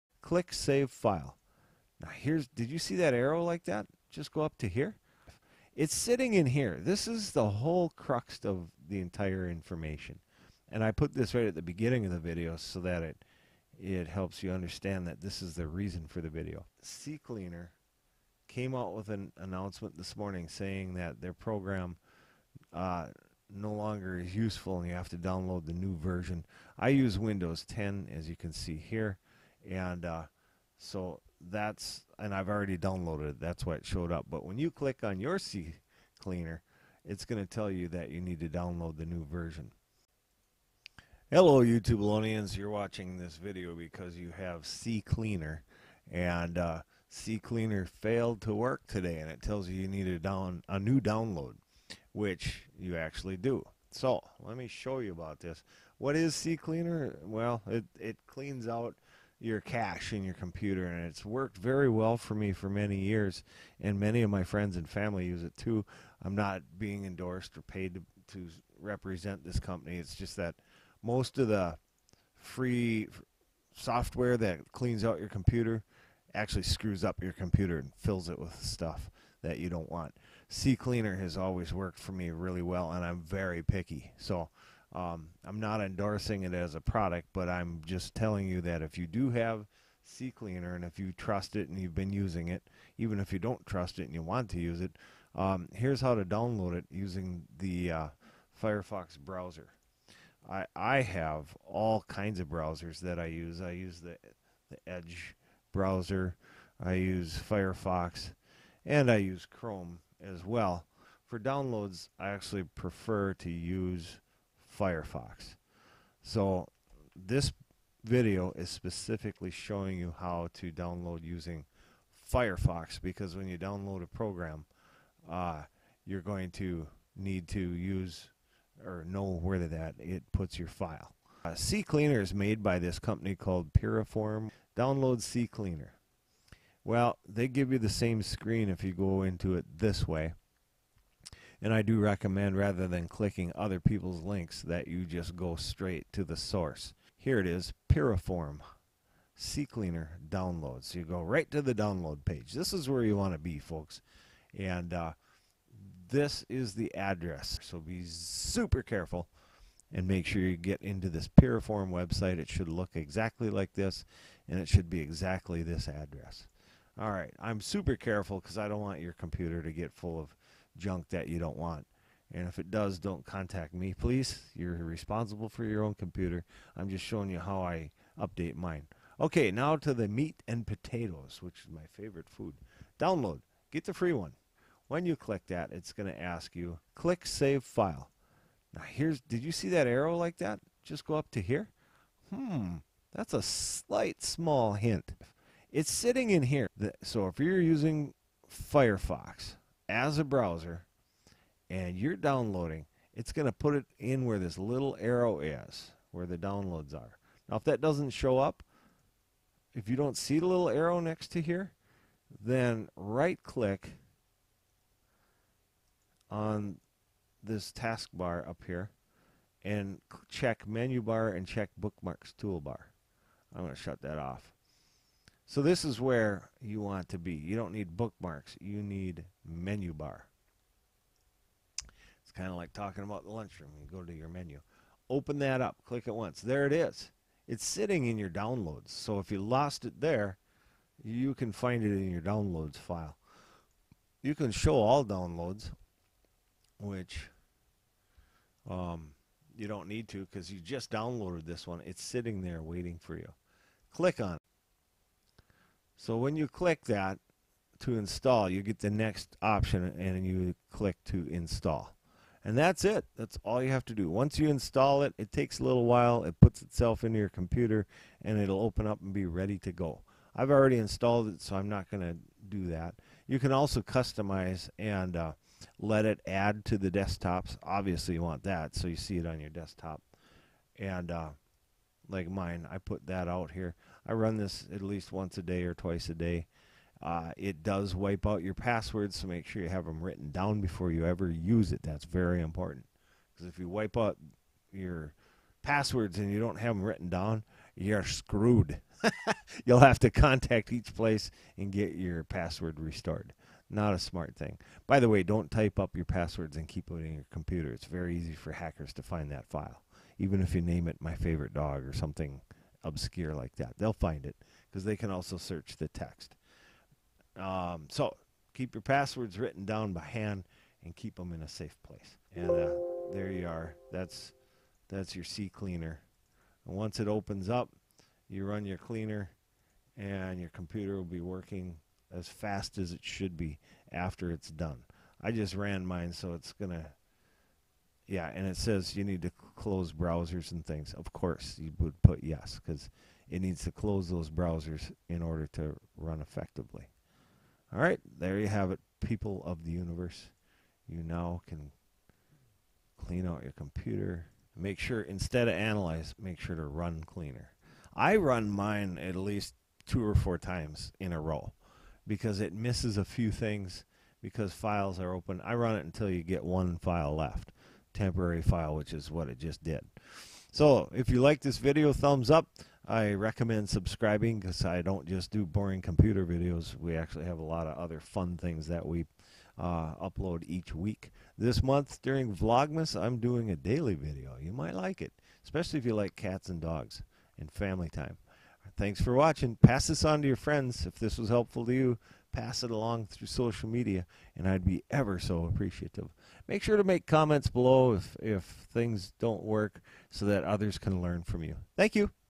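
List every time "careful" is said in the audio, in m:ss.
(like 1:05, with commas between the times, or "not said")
2:38, 2:47.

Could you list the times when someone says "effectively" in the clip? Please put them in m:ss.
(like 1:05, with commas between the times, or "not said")
5:46.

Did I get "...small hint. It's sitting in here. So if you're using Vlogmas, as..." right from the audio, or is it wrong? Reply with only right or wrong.
wrong.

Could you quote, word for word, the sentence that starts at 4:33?
You can also customize and uh, let it add to the desktops.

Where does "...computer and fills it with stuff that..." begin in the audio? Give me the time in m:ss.
1:17.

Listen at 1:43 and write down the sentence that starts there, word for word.
I use the, the Edge browser, I use Firefox, and I use Chrome as well.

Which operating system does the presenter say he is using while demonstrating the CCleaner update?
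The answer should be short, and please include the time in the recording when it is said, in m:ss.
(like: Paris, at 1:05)
Windows 10, at 0:27.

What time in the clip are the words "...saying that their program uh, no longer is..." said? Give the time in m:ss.
0:20.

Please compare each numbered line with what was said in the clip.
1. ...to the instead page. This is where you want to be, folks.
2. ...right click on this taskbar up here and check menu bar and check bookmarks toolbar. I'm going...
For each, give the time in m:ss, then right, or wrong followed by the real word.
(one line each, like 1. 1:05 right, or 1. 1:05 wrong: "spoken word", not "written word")
1. 2:31 wrong: "download", not "instead"
2. 3:32 right.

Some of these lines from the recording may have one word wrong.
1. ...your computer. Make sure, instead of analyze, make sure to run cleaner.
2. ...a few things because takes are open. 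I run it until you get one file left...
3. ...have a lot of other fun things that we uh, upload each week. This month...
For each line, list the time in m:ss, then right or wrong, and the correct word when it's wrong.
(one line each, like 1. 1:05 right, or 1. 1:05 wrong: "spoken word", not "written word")
1. 5:53 right
2. 6:02 wrong: "files", not "takes"
3. 6:17 right.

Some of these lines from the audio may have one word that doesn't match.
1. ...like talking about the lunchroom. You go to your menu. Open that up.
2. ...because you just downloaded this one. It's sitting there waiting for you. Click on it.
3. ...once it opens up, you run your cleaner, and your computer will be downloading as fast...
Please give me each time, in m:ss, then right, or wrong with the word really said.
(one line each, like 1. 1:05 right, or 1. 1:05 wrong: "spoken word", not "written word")
1. 3:52 right
2. 4:10 right
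3. 5:26 wrong: "working", not "downloading".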